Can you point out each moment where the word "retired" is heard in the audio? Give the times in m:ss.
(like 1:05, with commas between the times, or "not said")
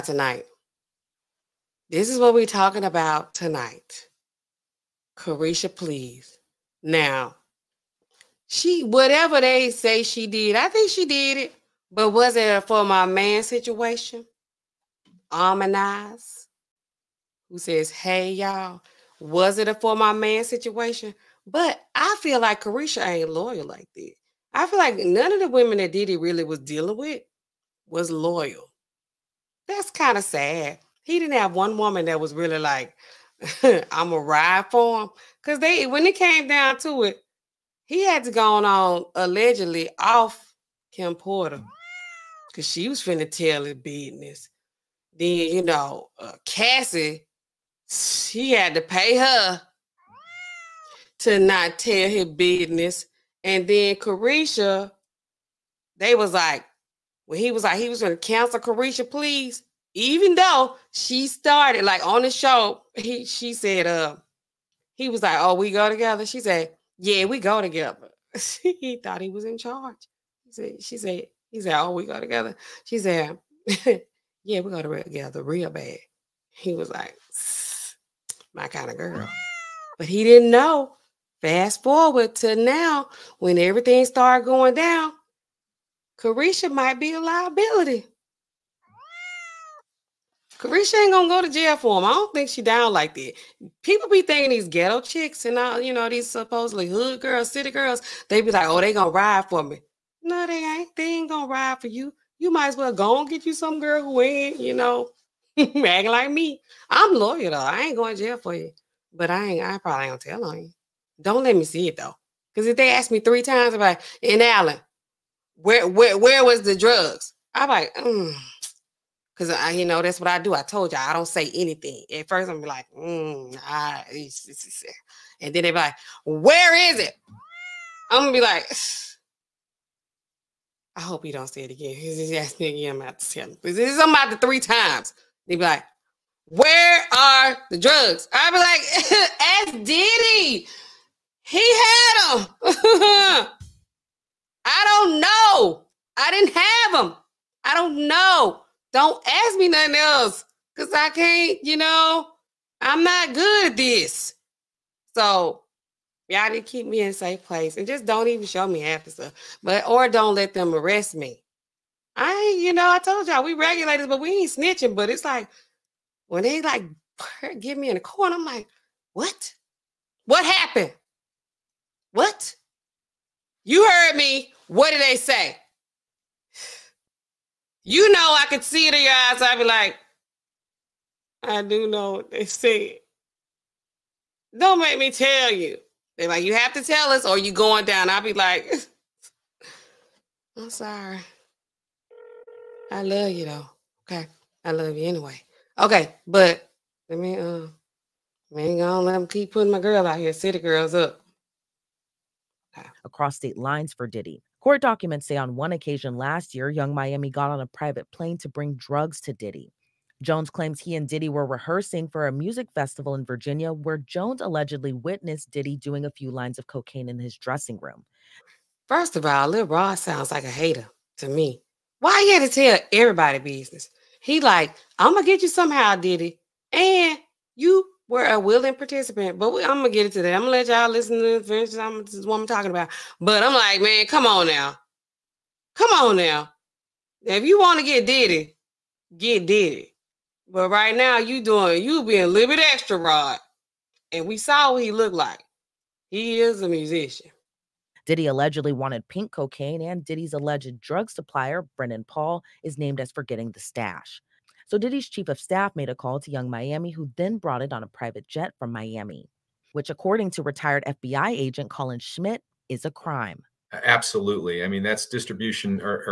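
4:20.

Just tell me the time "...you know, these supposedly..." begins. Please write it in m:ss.
1:35.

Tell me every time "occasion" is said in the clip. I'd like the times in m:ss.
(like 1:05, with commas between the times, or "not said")
3:25.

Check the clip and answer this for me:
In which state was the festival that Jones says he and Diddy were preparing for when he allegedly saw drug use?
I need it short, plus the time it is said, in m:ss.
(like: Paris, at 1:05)
Virginia, at 3:33.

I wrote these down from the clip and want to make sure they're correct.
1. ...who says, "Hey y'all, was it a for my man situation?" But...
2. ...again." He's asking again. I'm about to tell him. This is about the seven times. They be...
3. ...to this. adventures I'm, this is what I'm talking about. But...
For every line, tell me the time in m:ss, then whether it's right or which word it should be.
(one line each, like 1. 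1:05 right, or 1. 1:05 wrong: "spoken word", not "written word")
1. 0:17 right
2. 2:11 wrong: "three", not "seven"
3. 3:51 right.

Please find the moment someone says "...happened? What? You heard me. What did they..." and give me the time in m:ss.
2:50.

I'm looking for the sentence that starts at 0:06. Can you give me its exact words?
Now, she whatever they say she did, I think she did it, but was it for my man situation?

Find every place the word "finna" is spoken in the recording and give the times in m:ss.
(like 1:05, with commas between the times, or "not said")
0:42.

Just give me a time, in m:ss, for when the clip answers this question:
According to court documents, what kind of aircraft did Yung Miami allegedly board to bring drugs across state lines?
3:27.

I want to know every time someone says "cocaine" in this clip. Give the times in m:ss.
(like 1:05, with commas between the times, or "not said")
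3:36, 4:09.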